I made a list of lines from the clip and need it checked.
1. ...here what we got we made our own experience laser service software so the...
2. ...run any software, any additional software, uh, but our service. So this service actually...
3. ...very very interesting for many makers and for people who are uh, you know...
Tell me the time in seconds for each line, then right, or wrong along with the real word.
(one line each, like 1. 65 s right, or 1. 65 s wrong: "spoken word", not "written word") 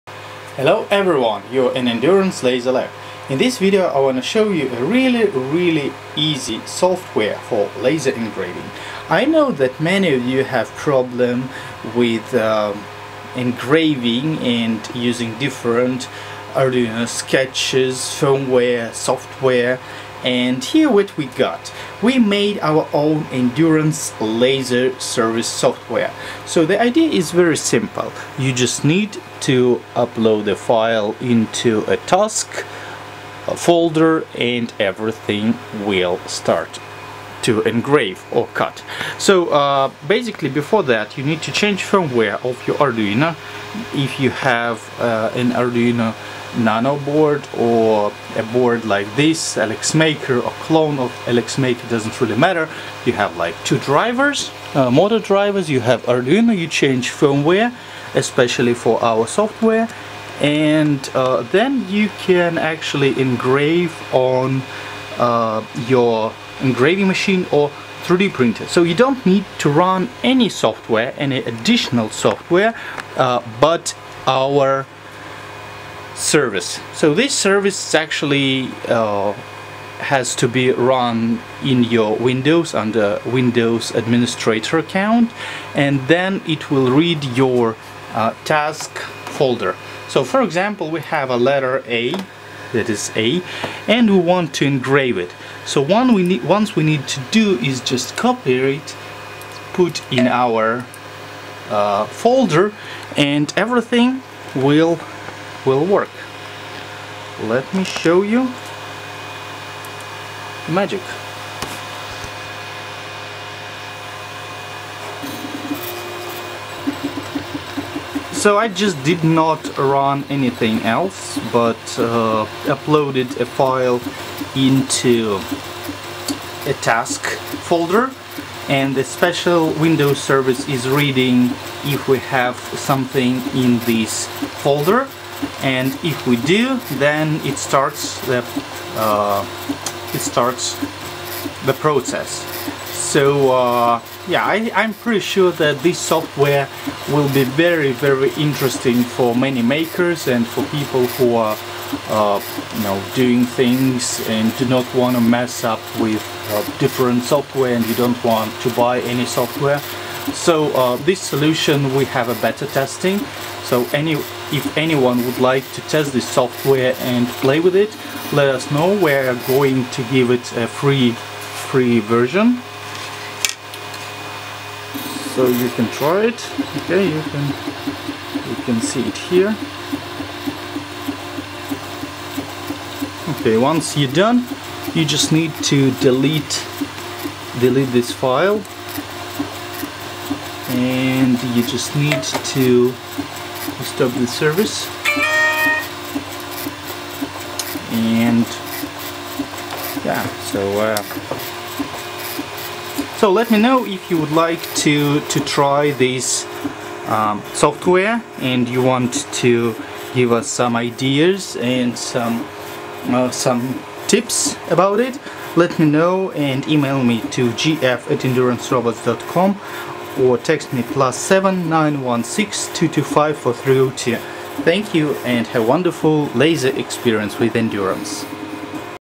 1. 20 s wrong: "endurance", not "experience"
2. 69 s right
3. 147 s right.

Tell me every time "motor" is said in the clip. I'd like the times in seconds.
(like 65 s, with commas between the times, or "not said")
54 s.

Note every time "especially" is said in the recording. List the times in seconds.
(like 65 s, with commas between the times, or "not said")
58 s.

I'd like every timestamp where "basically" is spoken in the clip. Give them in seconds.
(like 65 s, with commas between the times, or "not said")
40 s.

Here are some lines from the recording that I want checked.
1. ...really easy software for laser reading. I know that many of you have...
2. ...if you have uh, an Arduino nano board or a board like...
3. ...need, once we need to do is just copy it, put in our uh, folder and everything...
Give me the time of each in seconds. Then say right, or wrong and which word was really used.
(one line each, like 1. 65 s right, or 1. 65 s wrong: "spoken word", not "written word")
1. 5 s wrong: "engraving", not "reading"
2. 43 s right
3. 96 s right.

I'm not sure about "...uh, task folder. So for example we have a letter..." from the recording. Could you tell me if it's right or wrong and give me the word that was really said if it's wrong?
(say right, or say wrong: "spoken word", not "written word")
right.